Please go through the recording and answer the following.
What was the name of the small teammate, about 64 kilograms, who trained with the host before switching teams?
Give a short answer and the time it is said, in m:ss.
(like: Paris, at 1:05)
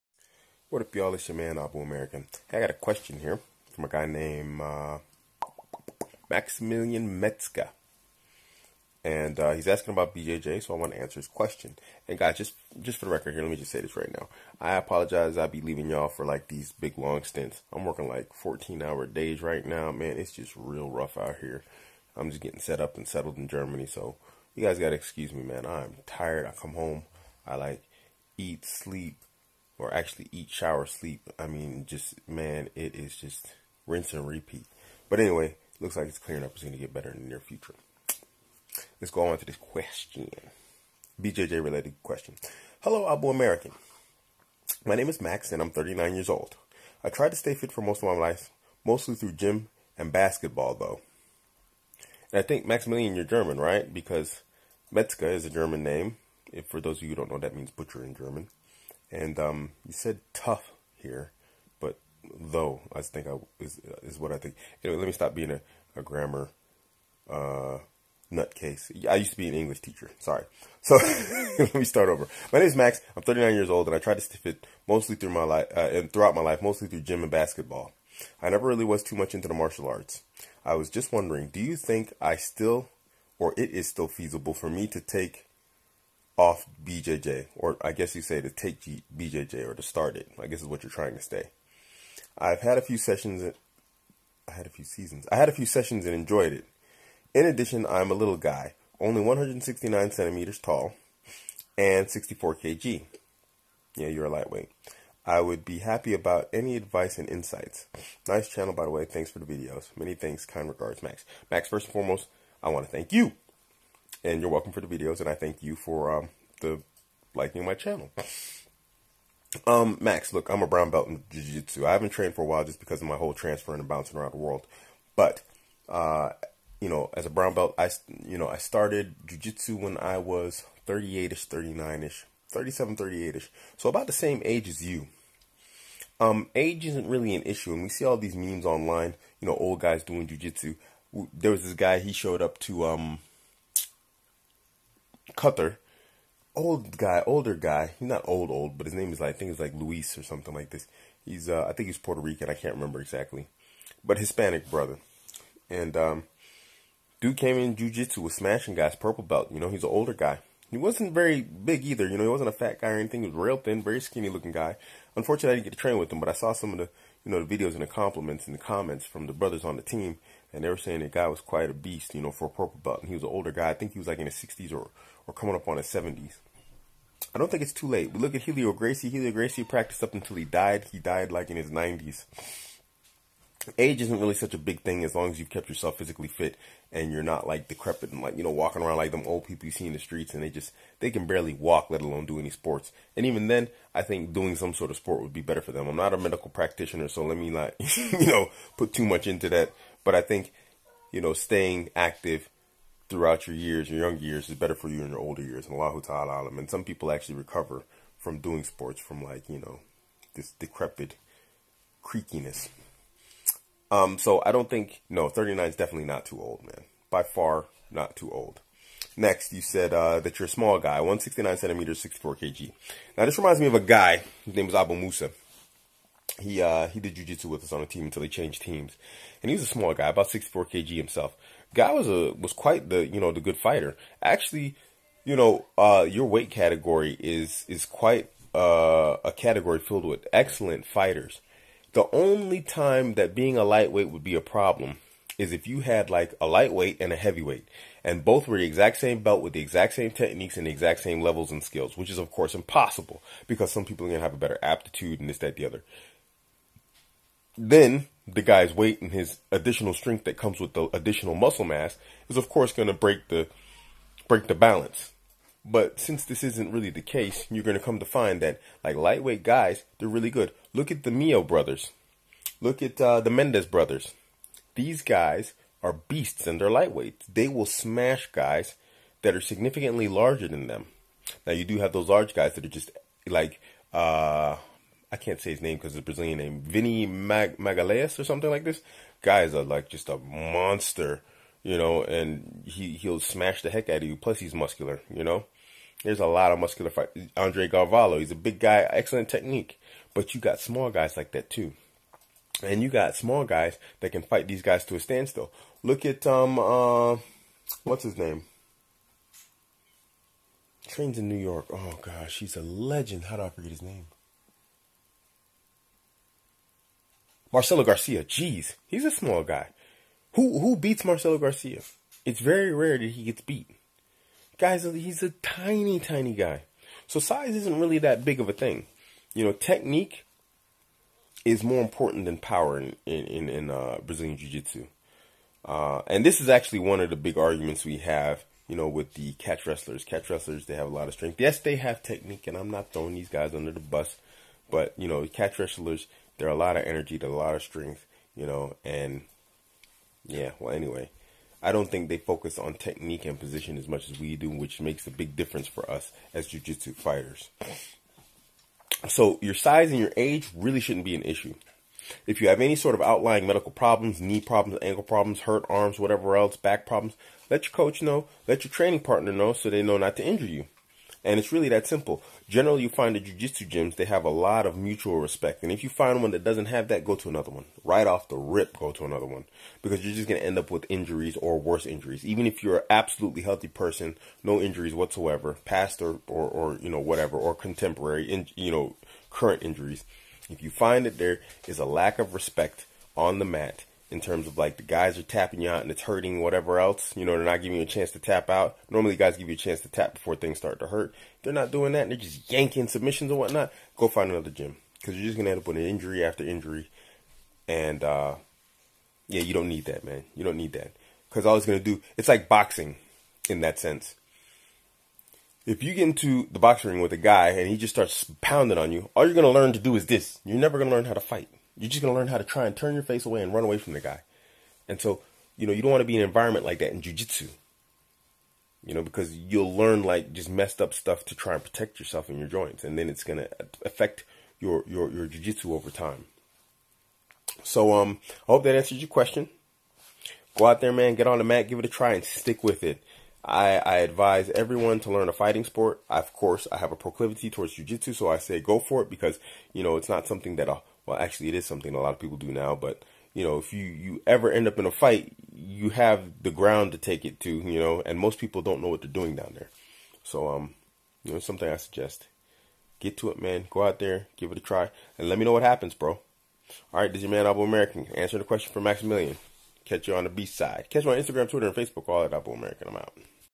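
Abu Musa, at 3:44.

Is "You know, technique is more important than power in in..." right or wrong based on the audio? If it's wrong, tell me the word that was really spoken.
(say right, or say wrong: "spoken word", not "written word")
right.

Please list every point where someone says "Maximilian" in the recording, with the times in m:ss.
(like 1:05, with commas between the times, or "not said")
0:06, 0:52, 7:48.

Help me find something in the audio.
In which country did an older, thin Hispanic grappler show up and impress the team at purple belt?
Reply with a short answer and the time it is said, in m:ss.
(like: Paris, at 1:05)
Qatar, at 2:25.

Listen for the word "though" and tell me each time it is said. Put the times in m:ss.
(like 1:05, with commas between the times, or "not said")
0:50, 1:02.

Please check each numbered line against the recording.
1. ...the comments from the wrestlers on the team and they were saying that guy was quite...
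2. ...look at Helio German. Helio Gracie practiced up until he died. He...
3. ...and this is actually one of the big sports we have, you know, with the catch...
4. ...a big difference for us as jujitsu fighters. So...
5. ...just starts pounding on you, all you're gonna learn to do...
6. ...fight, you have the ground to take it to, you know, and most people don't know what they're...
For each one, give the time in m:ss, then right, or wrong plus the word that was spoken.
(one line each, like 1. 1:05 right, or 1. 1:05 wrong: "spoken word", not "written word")
1. 2:48 wrong: "brothers", not "wrestlers"
2. 2:58 wrong: "Gracie", not "German"
3. 5:36 wrong: "arguments", not "sports"
4. 5:55 right
5. 6:57 right
6. 7:34 right.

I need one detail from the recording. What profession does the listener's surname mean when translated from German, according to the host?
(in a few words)
Butcher.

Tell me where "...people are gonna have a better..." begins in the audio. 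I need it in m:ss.
4:13.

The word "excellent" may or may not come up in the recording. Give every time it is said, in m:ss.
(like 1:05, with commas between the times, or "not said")
4:00, 4:58.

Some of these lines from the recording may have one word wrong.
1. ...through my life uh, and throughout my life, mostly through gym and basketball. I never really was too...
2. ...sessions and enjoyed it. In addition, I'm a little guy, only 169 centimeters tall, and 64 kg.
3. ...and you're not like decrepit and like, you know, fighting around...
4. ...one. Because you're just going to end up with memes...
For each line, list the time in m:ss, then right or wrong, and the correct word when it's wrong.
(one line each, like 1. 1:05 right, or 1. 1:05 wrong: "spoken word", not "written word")
1. 1:15 right
2. 1:35 right
3. 3:06 wrong: "walking", not "fighting"
4. 6:19 wrong: "injuries", not "memes".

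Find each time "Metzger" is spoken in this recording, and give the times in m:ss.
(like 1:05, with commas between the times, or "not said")
0:07, 0:54.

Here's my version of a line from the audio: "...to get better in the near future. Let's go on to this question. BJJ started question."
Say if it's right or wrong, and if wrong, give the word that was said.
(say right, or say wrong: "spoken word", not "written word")
wrong: "related", not "started".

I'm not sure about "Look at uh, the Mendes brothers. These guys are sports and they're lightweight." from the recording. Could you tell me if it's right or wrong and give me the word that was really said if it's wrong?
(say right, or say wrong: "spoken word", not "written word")
wrong: "beasts", not "sports".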